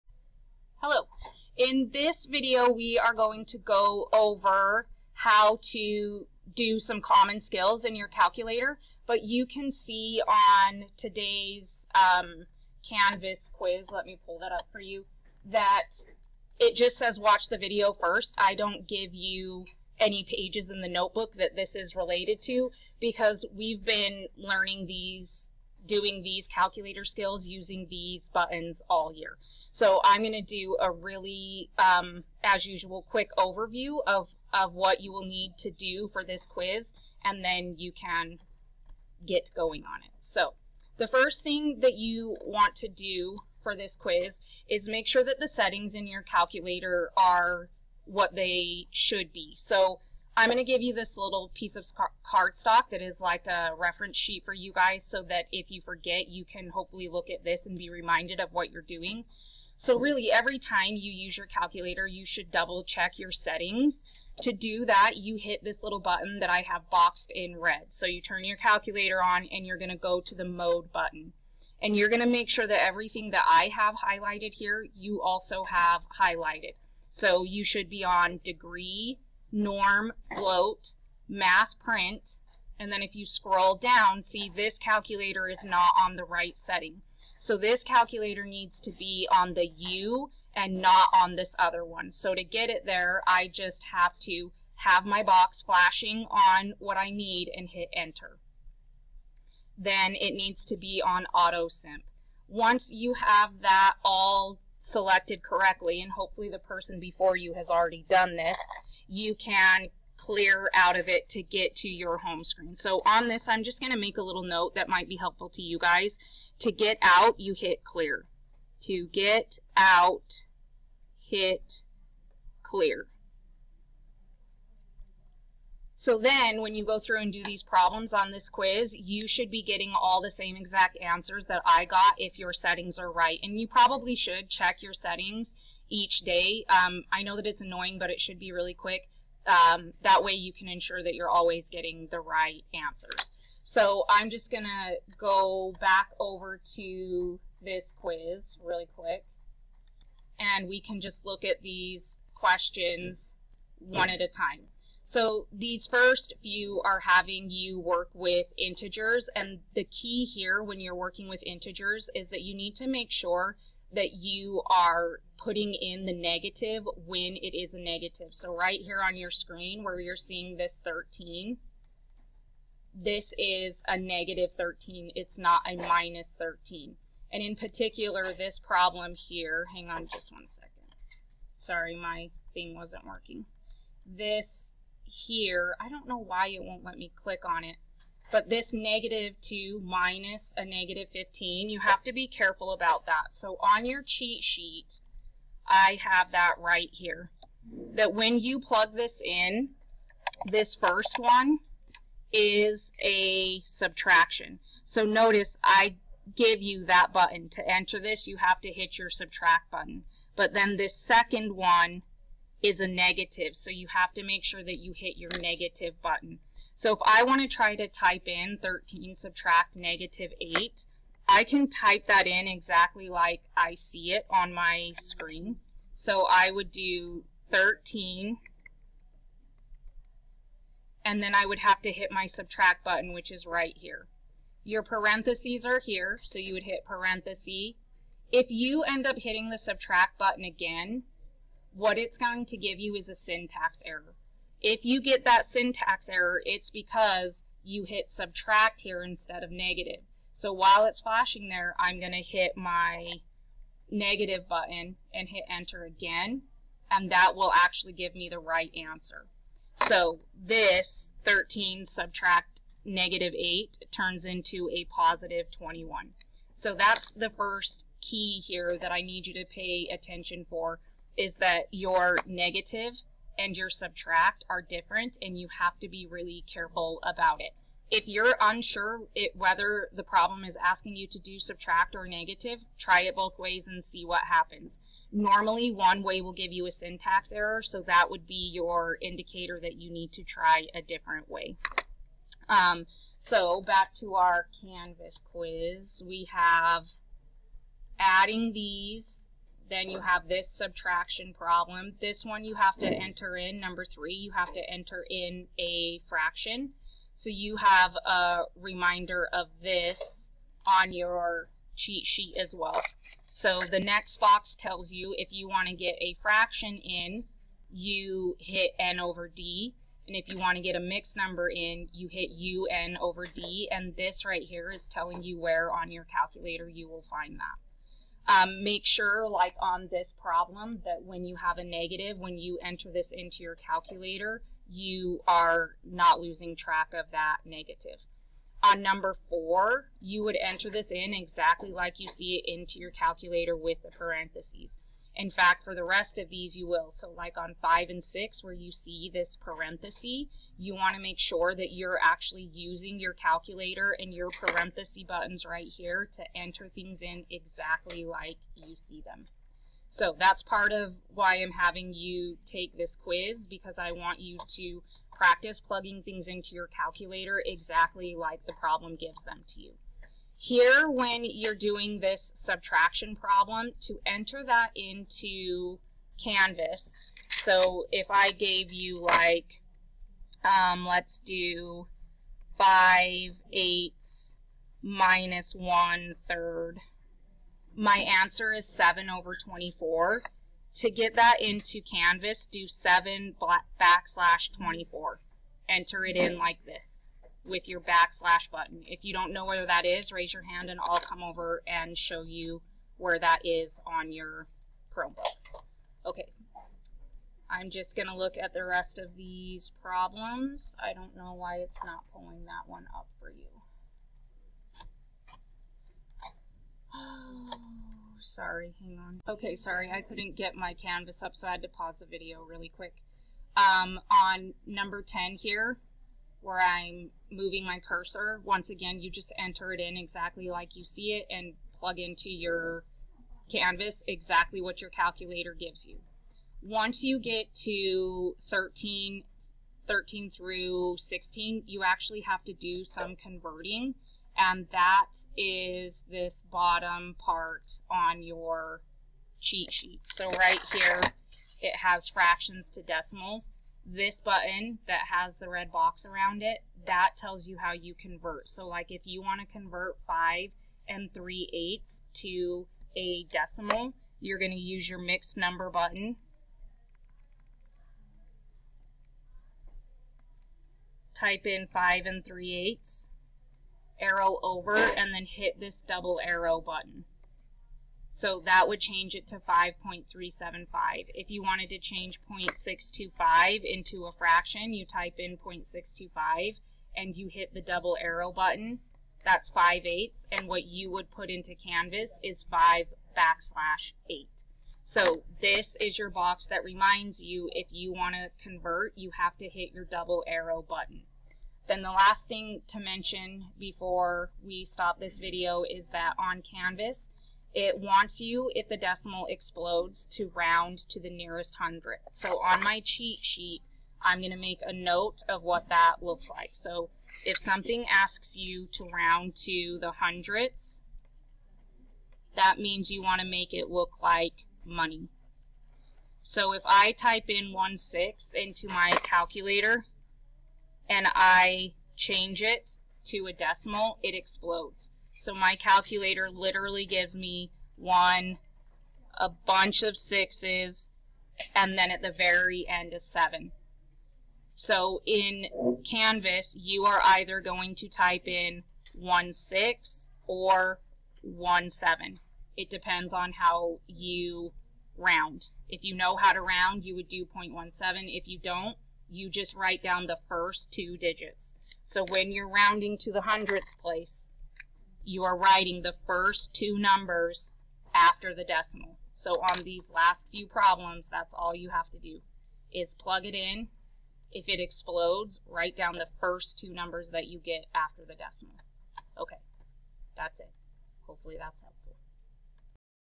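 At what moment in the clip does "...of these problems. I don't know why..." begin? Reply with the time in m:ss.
6:48.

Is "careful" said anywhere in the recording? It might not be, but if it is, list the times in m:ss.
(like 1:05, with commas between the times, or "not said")
3:12, 4:36.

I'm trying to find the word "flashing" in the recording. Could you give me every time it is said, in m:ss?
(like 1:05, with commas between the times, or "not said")
1:35, 4:10.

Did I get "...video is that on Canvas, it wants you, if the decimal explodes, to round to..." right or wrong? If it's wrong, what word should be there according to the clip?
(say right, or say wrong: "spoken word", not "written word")
right.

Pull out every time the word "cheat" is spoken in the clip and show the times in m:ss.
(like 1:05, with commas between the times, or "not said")
3:14, 5:11, 7:29, 8:32.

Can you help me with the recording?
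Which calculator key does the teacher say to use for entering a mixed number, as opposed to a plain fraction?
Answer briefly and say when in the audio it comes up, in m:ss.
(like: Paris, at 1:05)
un over d, at 5:22.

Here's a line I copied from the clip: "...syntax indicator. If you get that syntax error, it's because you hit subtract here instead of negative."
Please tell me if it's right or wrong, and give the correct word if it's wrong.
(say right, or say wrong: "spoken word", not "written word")
wrong: "error", not "indicator".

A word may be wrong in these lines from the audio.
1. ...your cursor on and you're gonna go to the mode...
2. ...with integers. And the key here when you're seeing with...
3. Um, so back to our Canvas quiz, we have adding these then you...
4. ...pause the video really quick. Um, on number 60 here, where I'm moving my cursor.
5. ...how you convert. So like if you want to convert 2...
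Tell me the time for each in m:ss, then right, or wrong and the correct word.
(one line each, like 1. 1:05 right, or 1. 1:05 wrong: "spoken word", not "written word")
1. 1:08 wrong: "calculator", not "cursor"
2. 2:38 wrong: "working", not "seeing"
3. 4:52 right
4. 7:01 wrong: "10", not "60"
5. 7:37 wrong: "5", not "2".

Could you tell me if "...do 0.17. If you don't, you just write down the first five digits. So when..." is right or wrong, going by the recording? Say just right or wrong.
wrong.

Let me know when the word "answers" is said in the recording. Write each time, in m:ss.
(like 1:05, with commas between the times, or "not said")
2:10, 2:22, 4:18, 6:27.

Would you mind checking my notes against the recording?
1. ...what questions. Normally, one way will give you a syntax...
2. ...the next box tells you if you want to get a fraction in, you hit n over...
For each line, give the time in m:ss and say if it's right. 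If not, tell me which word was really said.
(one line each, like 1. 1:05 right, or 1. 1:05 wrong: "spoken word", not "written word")
1. 4:44 wrong: "happens", not "questions"
2. 5:13 right.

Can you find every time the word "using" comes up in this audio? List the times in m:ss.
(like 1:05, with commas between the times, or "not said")
0:27, 5:52.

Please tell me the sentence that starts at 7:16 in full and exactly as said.
Once you get to 13, 13 through 16, you actually have to do some converting.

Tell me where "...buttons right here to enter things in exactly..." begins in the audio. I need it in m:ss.
5:55.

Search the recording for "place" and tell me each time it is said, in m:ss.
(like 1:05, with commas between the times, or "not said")
9:23.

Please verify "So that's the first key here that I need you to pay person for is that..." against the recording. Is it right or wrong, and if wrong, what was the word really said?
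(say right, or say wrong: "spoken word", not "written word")
wrong: "attention", not "person".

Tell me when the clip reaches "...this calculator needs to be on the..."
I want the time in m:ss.
1:27.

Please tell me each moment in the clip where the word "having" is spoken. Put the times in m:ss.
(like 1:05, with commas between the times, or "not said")
2:36, 6:01.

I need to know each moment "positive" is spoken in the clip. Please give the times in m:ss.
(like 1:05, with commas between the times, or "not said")
4:24.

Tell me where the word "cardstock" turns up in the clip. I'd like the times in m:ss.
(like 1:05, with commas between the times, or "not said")
0:52.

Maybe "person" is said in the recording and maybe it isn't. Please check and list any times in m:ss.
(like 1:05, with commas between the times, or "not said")
1:46.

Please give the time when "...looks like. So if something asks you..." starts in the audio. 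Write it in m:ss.
8:36.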